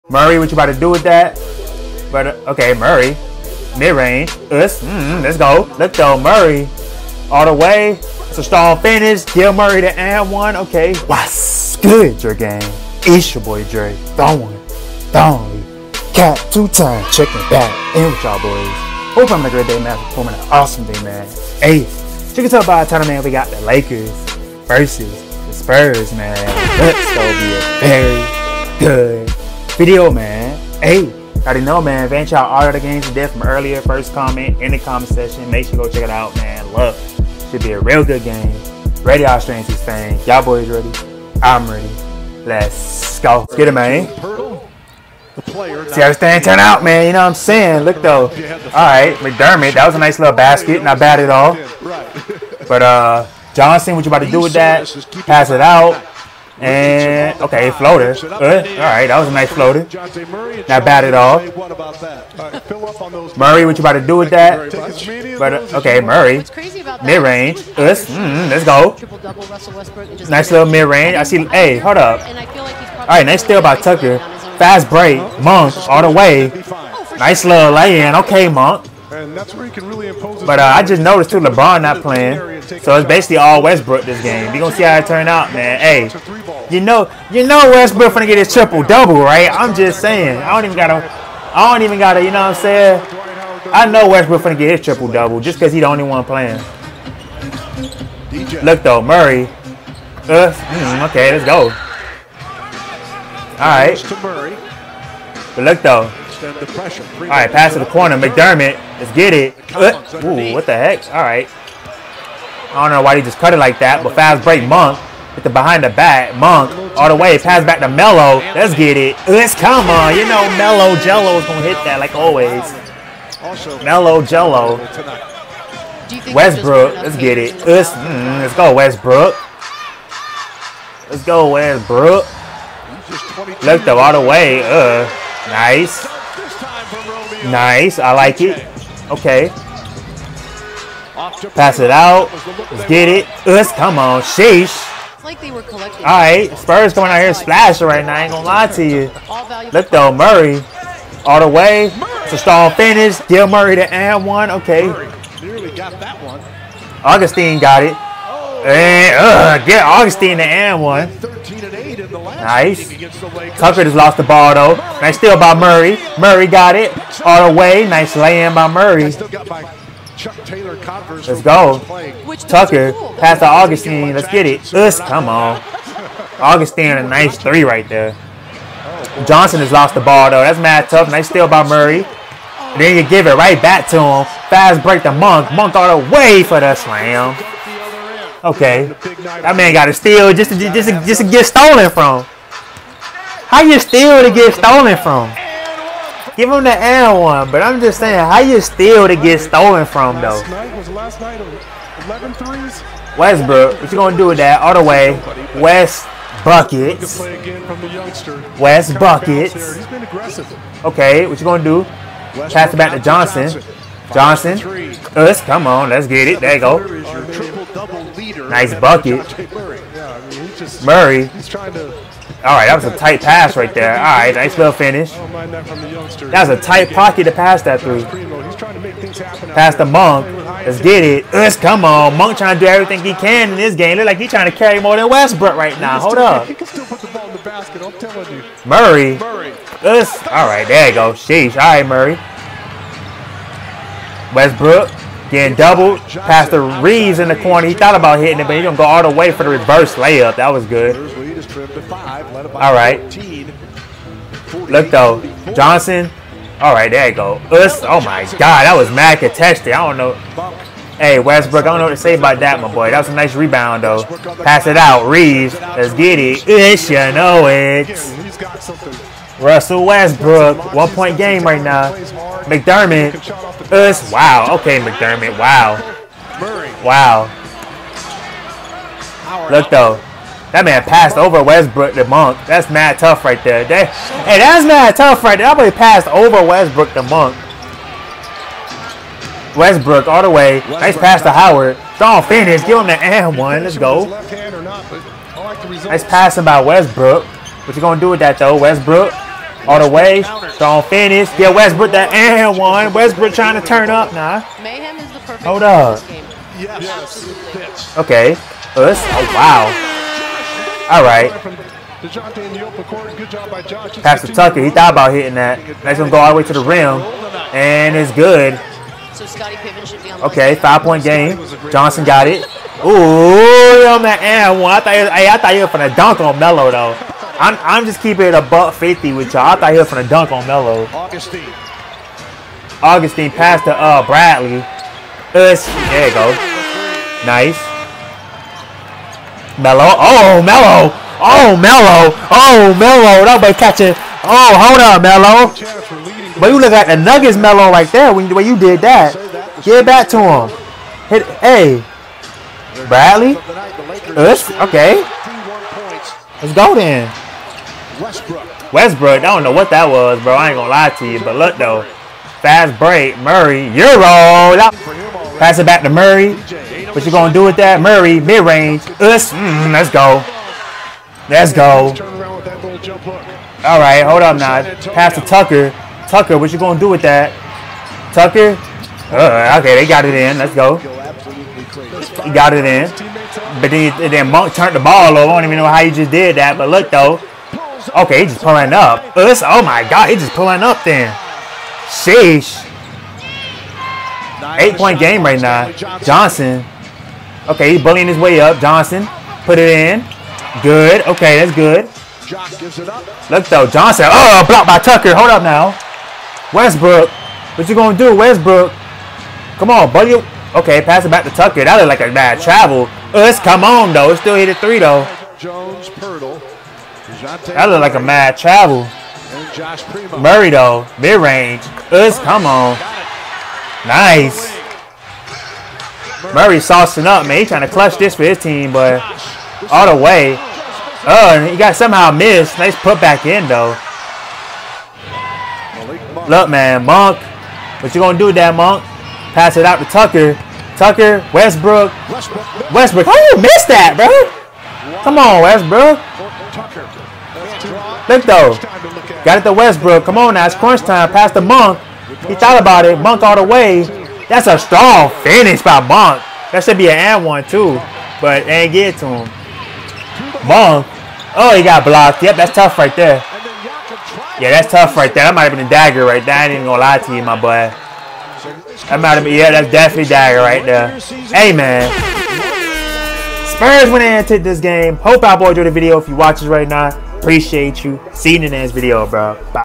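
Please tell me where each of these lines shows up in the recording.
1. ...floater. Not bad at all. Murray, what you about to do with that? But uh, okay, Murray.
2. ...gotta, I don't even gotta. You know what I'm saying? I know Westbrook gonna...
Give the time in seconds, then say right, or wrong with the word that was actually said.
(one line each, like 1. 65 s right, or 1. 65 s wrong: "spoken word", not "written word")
1. 59 s right
2. 90 s right.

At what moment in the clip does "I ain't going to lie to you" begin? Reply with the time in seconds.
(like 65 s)
148 s.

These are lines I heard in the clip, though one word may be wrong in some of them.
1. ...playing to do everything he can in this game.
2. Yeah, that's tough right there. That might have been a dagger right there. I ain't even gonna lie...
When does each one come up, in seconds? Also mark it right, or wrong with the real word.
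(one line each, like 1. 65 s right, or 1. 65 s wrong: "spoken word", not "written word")
1. 232 s wrong: "trying", not "playing"
2. 464 s right.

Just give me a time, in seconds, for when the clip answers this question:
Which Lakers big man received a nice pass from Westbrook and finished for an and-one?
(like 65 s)
291 s.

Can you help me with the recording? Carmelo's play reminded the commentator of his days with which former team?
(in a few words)
Nuggets.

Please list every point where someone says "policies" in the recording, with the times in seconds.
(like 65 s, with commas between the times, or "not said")
not said.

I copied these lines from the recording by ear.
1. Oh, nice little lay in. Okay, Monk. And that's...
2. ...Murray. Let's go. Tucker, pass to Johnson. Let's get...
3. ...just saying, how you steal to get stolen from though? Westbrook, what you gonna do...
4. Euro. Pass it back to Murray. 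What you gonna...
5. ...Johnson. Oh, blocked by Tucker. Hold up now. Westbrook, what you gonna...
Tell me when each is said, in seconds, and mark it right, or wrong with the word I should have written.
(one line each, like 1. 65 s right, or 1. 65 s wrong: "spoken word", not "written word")
1. 76 s right
2. 168 s wrong: "Augustine", not "Johnson"
3. 197 s right
4. 363 s right
5. 403 s right.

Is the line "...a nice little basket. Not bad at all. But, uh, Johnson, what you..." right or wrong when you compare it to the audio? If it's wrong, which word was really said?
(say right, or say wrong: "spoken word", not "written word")
right.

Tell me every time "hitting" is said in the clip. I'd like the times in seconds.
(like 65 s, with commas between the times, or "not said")
248 s, 315 s.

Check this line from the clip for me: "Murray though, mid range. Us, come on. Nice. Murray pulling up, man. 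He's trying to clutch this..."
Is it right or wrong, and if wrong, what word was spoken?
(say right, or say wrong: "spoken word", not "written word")
wrong: "saucing", not "pulling".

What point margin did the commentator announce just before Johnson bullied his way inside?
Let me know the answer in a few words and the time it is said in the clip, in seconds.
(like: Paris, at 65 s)
8, at 394 s.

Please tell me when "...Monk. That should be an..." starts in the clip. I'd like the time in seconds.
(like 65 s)
455 s.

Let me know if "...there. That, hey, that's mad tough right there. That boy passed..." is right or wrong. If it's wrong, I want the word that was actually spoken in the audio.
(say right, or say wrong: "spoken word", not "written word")
right.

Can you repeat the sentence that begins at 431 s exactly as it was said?
Oh, and he got somehow missed.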